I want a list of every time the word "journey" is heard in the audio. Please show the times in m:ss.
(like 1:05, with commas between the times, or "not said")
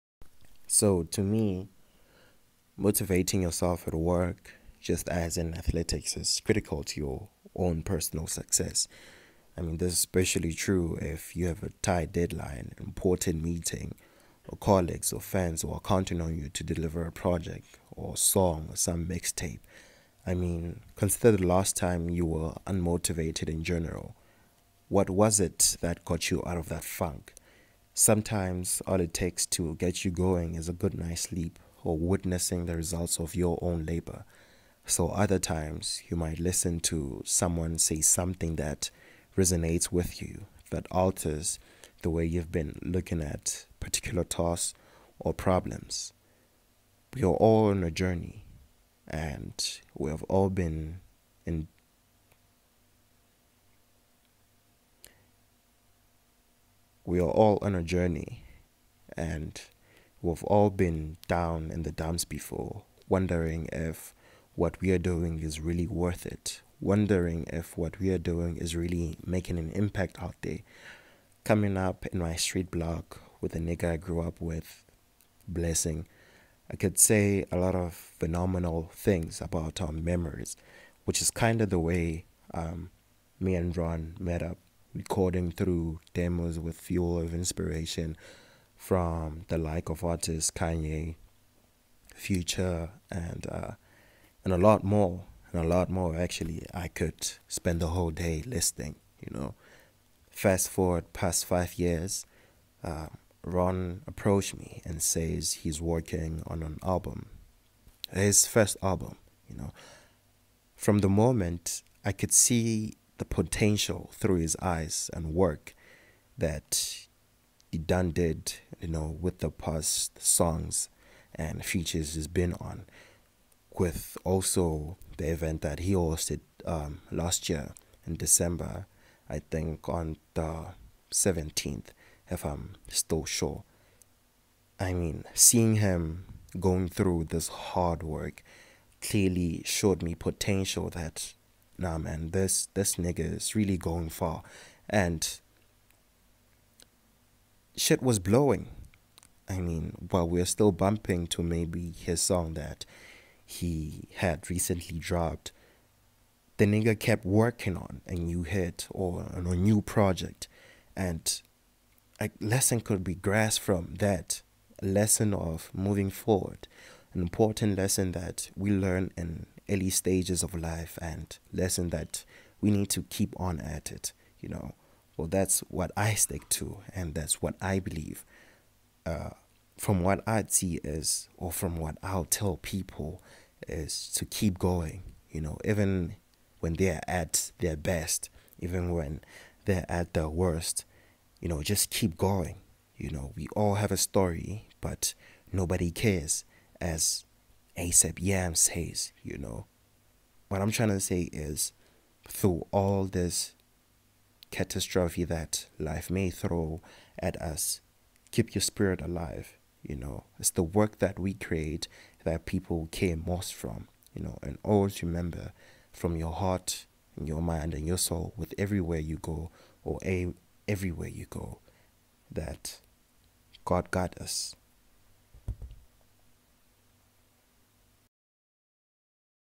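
0:47, 0:57.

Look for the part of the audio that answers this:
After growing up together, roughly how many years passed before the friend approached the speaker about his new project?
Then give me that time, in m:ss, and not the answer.
1:41.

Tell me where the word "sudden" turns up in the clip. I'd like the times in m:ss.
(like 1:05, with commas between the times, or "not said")
not said.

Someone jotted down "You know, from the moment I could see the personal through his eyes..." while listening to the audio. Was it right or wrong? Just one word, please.
wrong.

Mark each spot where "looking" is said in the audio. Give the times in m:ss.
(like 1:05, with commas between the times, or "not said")
0:42.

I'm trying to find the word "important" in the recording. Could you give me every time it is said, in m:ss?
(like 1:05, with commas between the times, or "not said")
0:12, 2:47.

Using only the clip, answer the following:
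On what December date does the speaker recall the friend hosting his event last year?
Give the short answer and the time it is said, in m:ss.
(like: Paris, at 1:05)
17th, at 2:11.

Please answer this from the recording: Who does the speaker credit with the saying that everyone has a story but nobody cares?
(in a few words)
ASAP Yam.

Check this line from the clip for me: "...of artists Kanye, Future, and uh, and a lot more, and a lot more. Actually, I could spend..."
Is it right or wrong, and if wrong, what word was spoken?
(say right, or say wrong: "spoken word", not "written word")
right.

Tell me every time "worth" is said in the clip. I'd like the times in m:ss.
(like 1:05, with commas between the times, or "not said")
1:05.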